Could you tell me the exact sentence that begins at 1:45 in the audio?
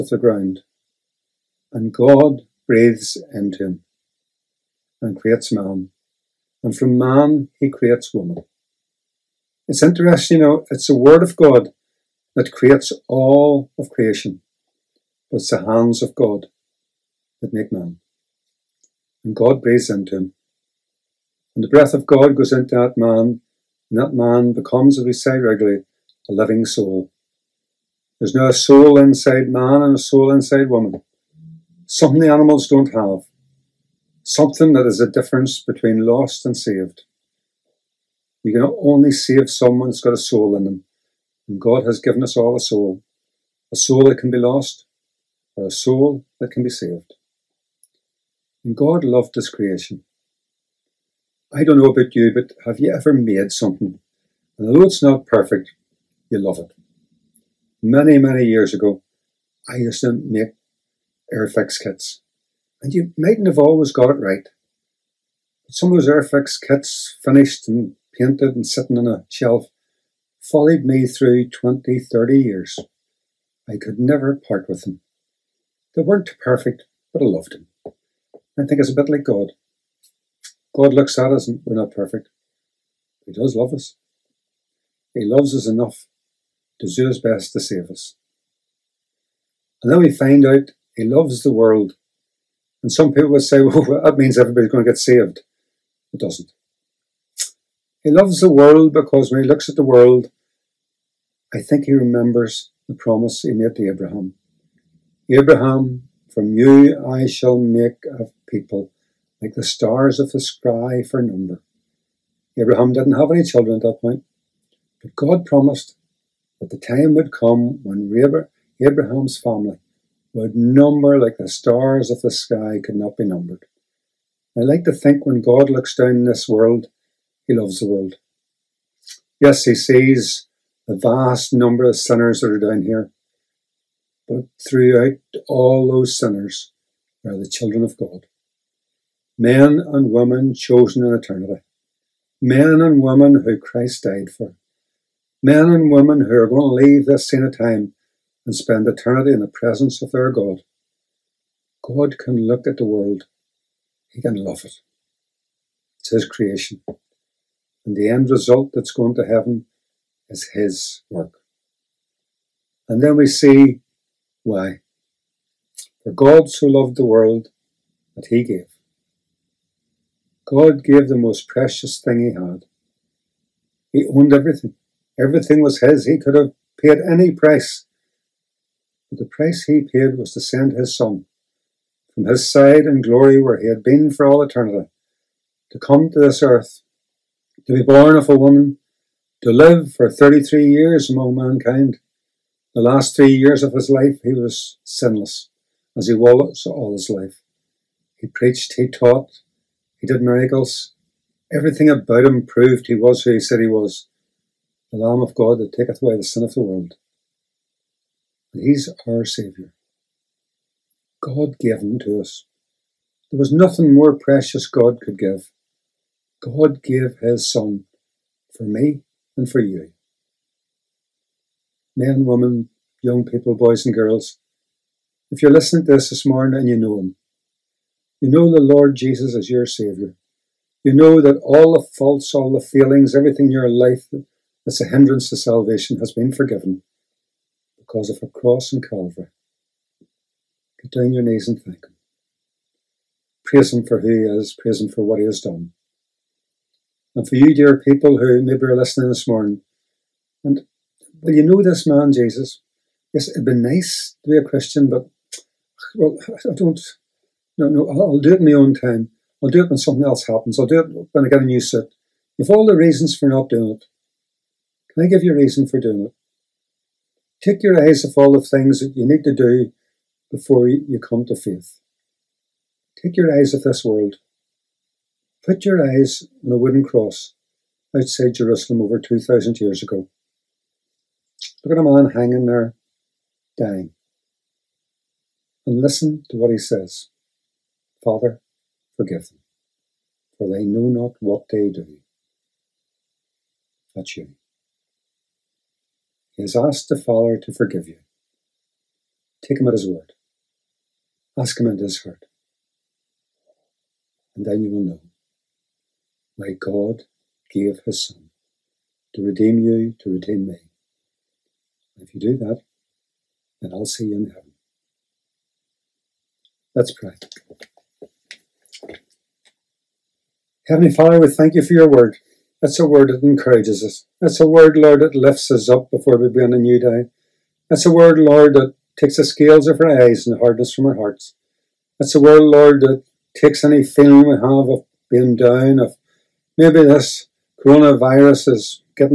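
Abraham, from you I shall make a people like the stars of the sky for number.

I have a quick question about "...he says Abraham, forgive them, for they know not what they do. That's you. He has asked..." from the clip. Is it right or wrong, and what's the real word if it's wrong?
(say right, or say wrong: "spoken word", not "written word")
wrong: "Father", not "Abraham".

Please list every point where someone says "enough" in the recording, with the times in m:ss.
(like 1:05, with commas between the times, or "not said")
1:25.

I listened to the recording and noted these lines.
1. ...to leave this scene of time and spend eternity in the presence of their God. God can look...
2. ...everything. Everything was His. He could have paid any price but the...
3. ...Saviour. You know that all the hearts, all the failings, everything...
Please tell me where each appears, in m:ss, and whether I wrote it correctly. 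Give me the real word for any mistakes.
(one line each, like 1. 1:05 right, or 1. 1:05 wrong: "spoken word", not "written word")
1. 2:26 right
2. 2:54 right
3. 3:49 wrong: "faults", not "hearts".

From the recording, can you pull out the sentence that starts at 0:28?
There's now a soul inside man and a soul inside woman.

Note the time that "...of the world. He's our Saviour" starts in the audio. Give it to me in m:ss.
3:26.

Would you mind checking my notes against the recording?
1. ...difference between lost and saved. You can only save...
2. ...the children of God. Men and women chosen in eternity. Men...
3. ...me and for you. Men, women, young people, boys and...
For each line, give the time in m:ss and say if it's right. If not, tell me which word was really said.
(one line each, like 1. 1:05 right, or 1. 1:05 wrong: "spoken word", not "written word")
1. 0:35 right
2. 2:17 right
3. 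3:38 right.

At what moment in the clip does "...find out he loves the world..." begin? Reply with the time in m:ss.
1:30.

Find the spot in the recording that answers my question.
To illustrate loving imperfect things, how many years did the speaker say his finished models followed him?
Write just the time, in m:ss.
1:11.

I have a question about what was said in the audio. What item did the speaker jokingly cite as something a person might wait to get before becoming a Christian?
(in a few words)
a new suit.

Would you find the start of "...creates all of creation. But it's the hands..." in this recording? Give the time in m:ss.
0:12.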